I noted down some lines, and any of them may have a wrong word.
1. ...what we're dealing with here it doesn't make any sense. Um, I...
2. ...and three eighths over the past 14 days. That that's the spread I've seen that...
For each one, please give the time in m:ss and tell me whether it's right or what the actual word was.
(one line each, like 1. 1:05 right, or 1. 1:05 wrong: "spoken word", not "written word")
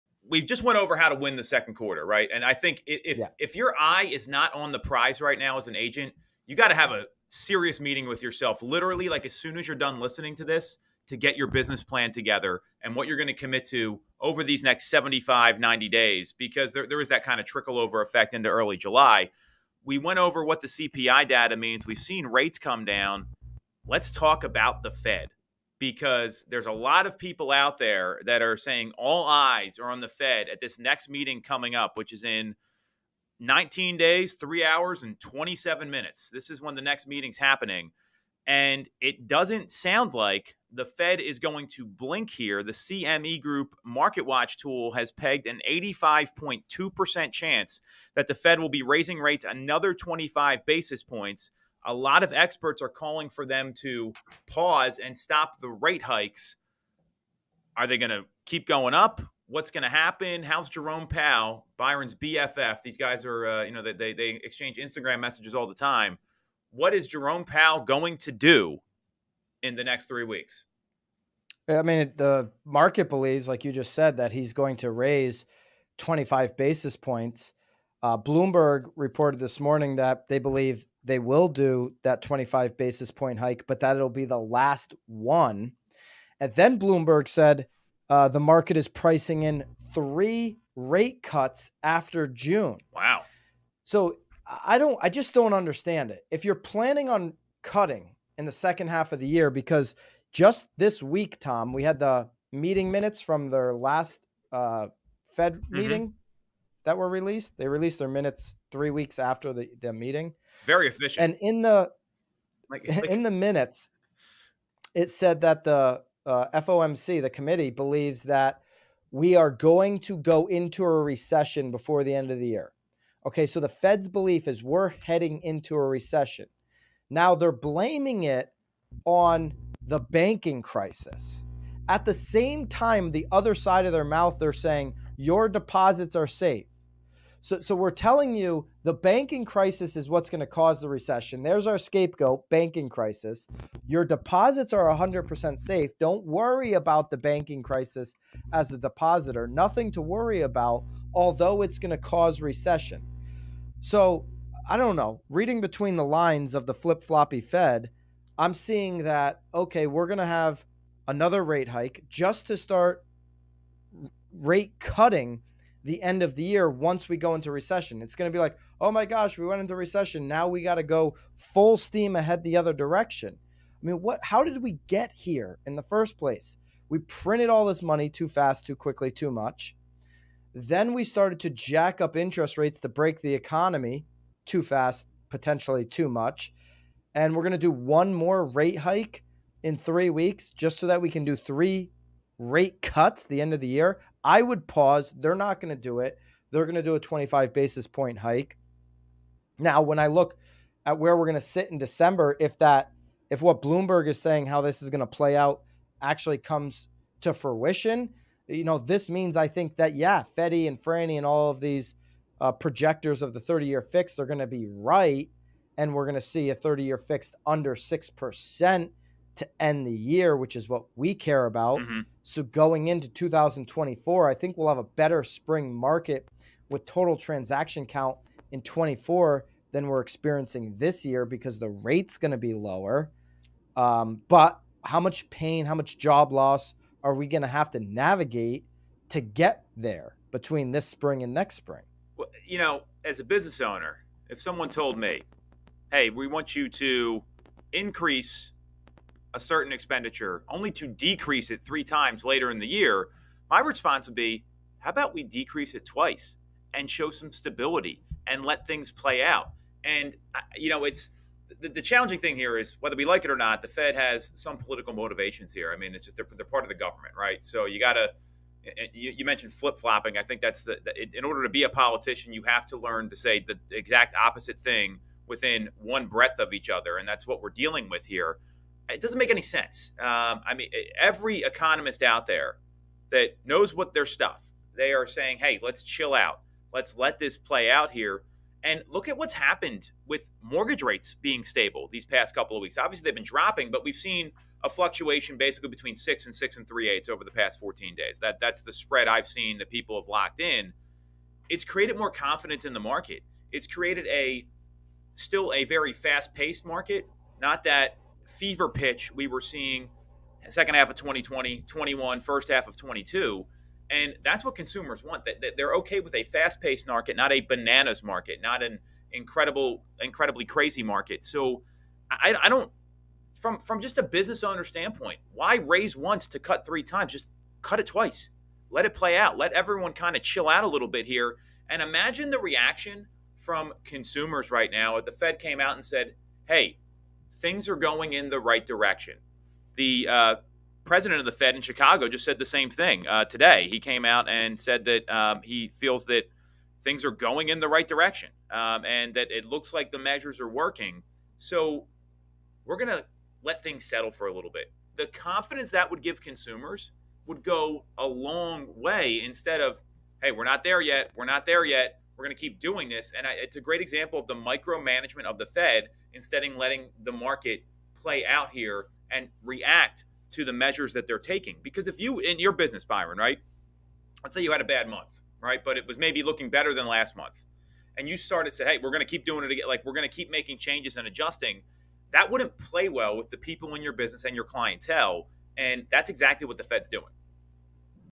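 1. 4:37 right
2. 4:56 right.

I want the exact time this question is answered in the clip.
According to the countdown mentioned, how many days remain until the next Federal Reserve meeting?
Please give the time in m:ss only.
0:33.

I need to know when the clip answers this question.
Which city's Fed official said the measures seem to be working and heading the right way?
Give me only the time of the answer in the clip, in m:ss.
5:41.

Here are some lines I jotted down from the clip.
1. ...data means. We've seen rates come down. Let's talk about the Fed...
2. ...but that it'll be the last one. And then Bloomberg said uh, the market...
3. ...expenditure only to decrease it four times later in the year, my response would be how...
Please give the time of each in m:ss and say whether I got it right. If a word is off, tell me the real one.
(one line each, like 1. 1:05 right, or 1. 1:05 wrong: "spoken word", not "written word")
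1. 0:21 right
2. 1:23 right
3. 4:09 wrong: "three", not "four".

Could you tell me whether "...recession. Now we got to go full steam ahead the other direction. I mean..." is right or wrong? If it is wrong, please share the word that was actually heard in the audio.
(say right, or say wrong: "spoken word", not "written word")
right.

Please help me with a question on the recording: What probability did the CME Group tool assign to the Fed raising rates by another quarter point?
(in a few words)
85.2%.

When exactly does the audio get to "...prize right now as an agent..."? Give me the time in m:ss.
0:04.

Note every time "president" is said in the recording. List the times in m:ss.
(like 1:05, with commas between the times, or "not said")
5:40.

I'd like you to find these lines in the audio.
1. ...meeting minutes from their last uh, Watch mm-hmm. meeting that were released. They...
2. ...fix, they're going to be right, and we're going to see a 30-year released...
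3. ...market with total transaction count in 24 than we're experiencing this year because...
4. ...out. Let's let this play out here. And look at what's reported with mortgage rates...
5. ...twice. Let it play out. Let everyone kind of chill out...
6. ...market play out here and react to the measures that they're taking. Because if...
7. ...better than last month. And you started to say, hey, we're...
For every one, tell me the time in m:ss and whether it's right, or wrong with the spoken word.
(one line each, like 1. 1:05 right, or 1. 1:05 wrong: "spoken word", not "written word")
1. 1:42 wrong: "Fed", not "Watch"
2. 3:33 wrong: "fixed", not "released"
3. 3:45 right
4. 4:46 wrong: "happened", not "reported"
5. 5:27 right
6. 6:07 right
7. 6:16 right.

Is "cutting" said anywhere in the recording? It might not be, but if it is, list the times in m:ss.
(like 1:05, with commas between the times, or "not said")
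1:37, 2:44.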